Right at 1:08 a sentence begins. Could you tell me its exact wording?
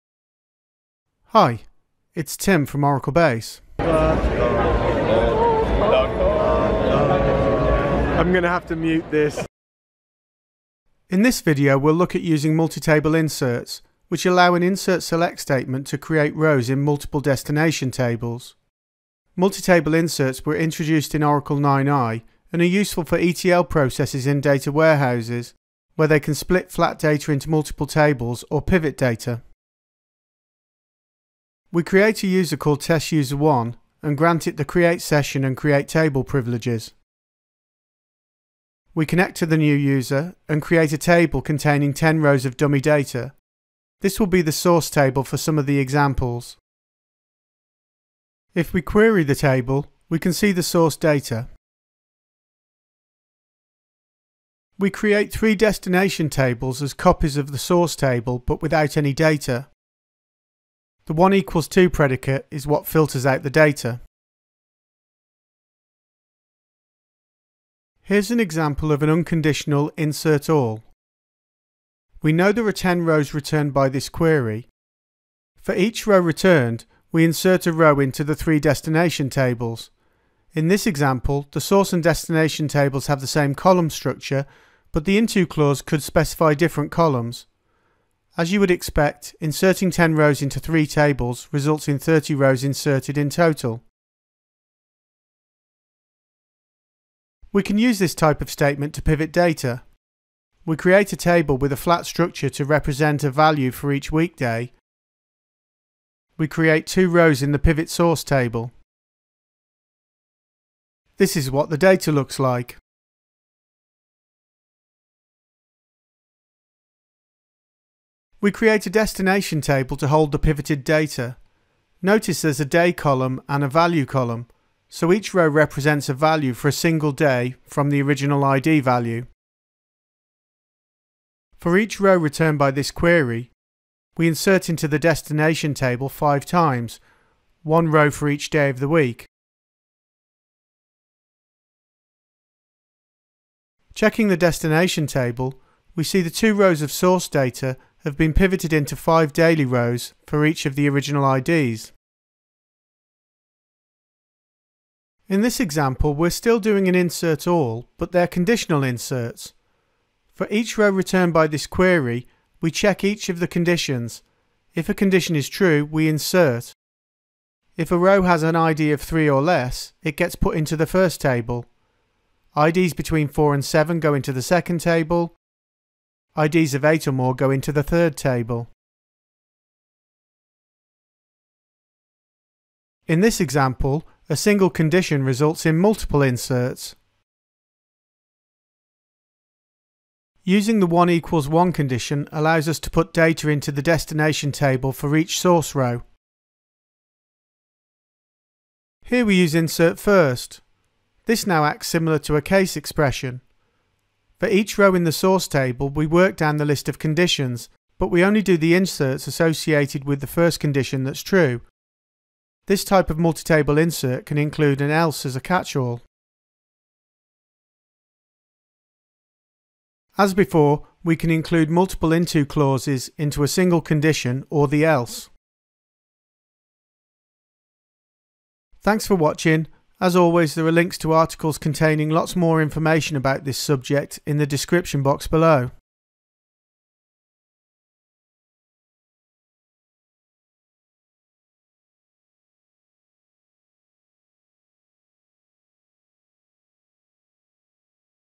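Here's an example of an unconditional insert all.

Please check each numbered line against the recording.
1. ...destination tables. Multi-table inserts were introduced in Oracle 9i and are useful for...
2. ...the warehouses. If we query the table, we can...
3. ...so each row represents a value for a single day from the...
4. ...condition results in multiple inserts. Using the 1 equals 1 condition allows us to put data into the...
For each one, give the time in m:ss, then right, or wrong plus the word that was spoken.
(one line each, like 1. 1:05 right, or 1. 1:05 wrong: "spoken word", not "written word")
1. 0:17 right
2. 0:45 wrong: "examples", not "warehouses"
3. 2:04 right
4. 3:04 right.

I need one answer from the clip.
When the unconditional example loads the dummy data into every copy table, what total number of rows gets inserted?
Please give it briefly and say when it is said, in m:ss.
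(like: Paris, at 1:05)
30, at 1:31.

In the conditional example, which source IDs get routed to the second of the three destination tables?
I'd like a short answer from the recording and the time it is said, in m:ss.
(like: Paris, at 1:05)
4 and 7, at 2:52.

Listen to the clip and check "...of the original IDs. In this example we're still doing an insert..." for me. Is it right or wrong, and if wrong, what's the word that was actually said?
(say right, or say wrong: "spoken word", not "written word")
right.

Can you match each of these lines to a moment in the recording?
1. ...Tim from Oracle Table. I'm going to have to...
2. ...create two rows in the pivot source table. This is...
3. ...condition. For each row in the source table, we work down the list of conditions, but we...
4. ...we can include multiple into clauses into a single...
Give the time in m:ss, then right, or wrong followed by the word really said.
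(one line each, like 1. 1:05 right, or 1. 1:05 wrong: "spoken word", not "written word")
1. 0:02 wrong: "Base", not "Table"
2. 1:46 right
3. 3:22 wrong: "expression", not "condition"
4. 3:41 right.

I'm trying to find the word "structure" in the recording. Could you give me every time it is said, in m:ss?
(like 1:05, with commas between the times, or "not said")
1:23, 1:42.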